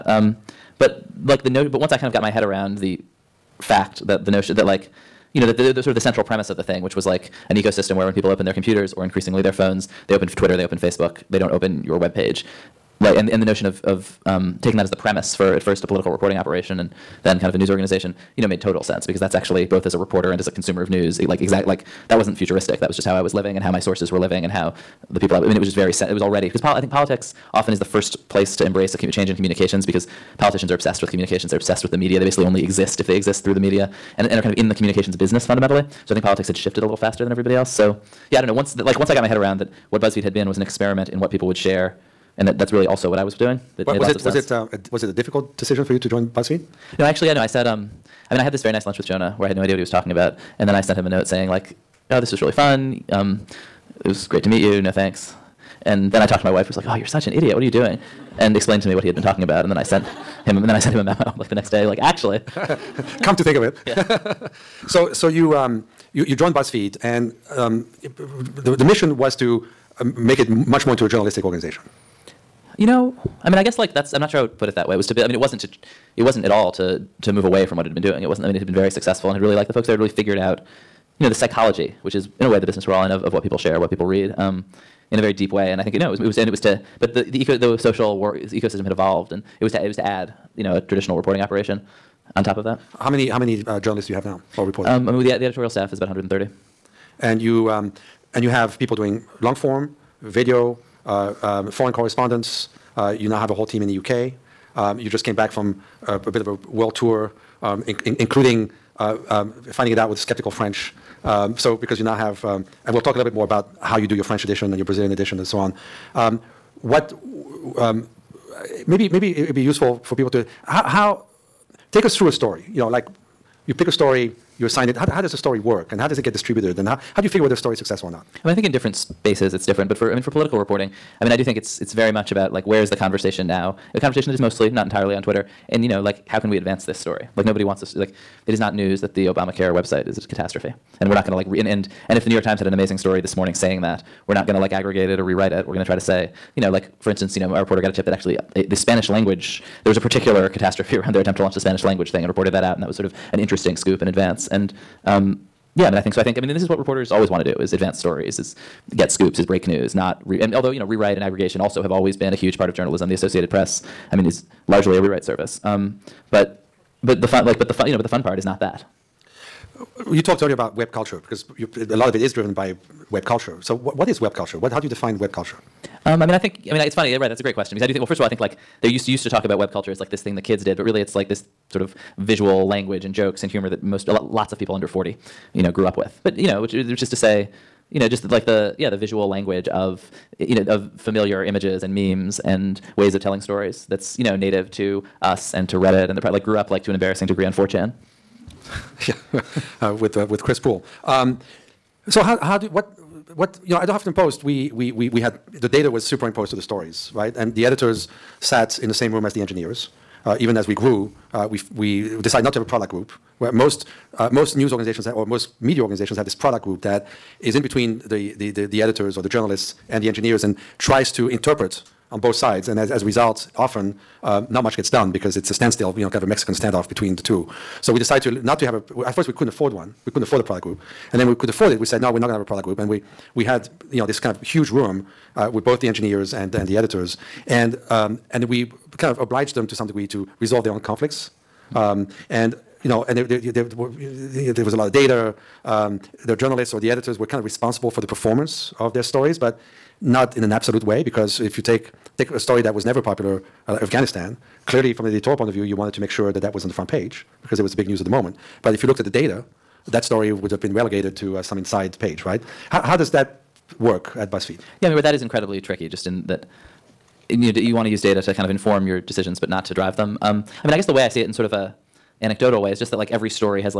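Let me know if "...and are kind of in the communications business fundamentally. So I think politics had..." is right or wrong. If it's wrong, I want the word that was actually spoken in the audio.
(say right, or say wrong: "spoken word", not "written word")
right.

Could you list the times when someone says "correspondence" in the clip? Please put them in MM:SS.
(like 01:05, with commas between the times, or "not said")
01:41.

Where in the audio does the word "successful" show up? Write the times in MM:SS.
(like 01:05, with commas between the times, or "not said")
01:18, 02:07.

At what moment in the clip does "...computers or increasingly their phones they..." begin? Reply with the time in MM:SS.
00:08.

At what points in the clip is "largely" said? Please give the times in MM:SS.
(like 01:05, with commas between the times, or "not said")
02:44.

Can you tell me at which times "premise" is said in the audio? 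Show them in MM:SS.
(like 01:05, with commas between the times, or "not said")
00:06, 00:14.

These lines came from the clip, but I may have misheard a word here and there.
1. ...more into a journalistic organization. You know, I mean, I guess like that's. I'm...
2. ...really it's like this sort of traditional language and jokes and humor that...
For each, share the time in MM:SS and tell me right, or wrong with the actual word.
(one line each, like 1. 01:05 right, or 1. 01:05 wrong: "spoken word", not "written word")
1. 01:10 right
2. 03:00 wrong: "visual", not "traditional".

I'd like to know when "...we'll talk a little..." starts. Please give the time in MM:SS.
01:52.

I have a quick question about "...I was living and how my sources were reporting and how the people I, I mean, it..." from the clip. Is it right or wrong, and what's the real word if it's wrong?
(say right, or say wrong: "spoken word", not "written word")
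wrong: "living", not "reporting".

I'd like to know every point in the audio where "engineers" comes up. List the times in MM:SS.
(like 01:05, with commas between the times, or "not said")
03:29, 03:40, 03:55.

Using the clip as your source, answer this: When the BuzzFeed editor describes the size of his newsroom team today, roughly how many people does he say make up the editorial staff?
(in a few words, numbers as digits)
130.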